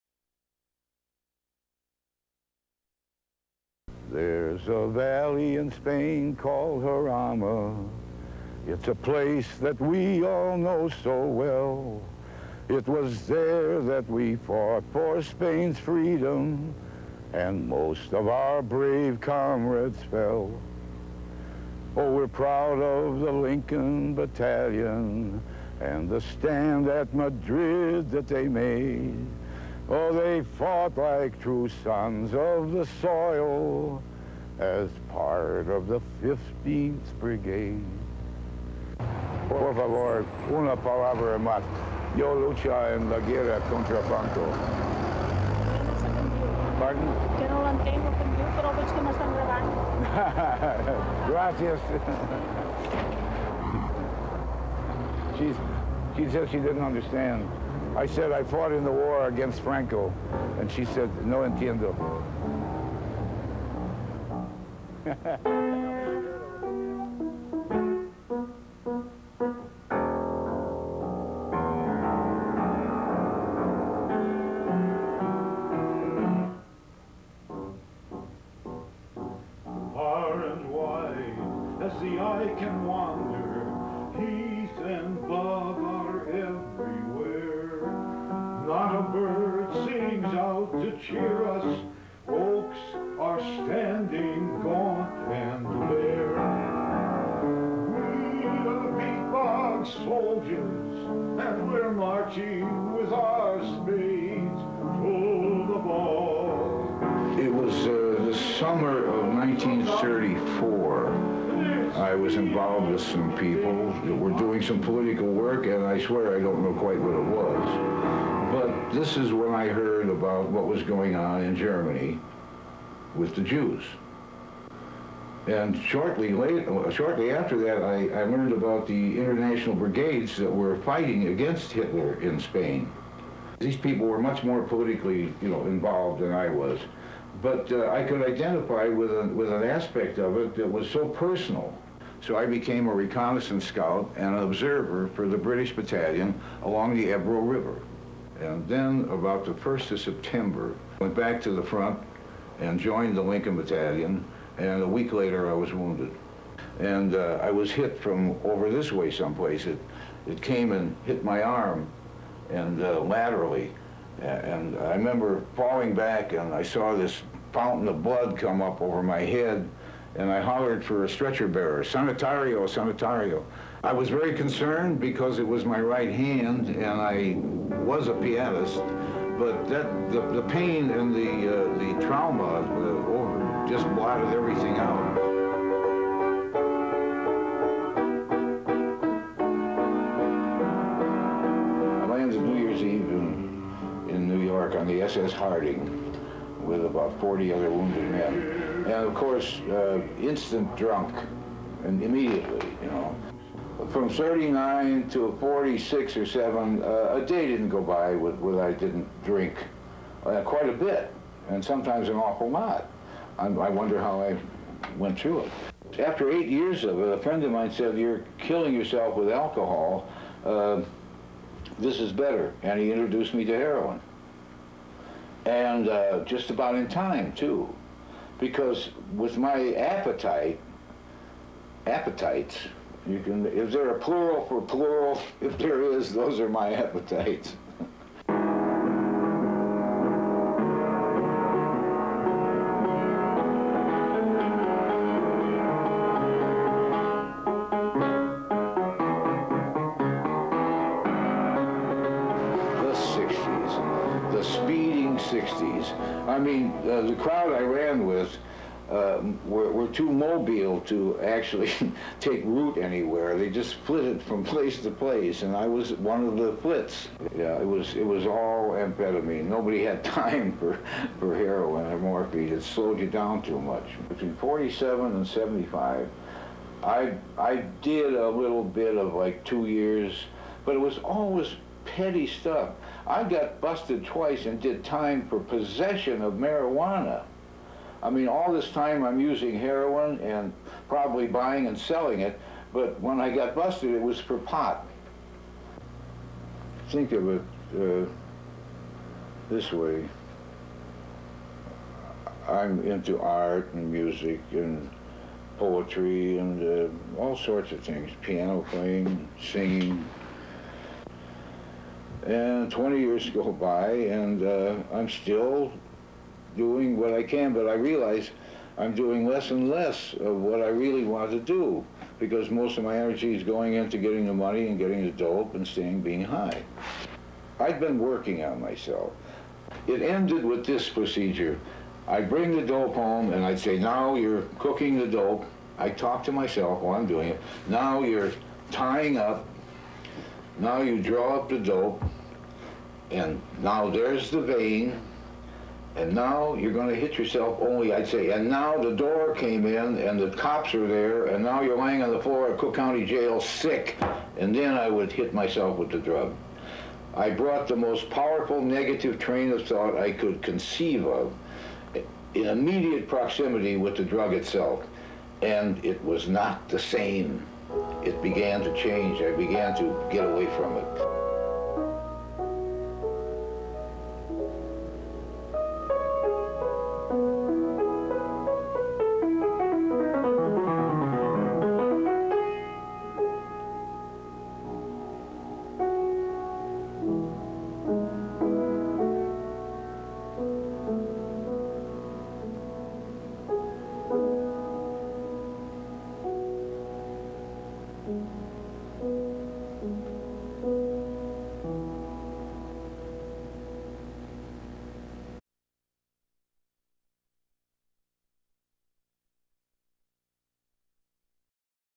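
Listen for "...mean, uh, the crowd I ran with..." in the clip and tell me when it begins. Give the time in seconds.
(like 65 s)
256 s.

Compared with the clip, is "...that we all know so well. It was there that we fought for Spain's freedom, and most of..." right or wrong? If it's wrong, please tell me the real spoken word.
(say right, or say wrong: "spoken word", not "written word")
right.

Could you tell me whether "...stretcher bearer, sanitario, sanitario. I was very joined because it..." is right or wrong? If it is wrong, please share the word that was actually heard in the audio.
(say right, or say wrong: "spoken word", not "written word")
wrong: "concerned", not "joined".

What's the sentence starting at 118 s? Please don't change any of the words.
This is when I heard about what was going on in Germany with the Jews.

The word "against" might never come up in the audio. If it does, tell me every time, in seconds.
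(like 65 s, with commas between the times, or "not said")
59 s, 131 s.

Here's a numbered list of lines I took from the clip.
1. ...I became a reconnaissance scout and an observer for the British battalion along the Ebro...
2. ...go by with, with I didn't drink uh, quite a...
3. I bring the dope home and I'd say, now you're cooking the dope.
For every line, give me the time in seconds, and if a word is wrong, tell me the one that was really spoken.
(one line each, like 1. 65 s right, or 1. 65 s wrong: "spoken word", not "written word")
1. 142 s right
2. 207 s right
3. 332 s right.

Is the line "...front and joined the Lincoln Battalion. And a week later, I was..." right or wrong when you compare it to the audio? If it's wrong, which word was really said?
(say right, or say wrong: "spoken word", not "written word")
right.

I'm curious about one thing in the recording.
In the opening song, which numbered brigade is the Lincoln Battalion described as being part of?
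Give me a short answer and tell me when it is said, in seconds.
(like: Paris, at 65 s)
15th Brigade, at 36 s.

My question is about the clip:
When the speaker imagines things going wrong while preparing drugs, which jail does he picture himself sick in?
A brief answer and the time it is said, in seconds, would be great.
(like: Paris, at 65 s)
Cook County Jail, at 352 s.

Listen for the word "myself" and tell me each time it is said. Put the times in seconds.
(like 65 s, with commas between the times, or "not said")
328 s, 336 s, 355 s.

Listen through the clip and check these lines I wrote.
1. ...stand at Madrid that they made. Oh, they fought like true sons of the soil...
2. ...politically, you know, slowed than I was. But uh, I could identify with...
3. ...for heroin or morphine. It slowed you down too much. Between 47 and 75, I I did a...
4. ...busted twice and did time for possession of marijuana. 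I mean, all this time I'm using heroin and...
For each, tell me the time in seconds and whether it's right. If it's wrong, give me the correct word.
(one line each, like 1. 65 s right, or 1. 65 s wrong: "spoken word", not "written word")
1. 26 s right
2. 134 s wrong: "involved", not "slowed"
3. 271 s right
4. 283 s right.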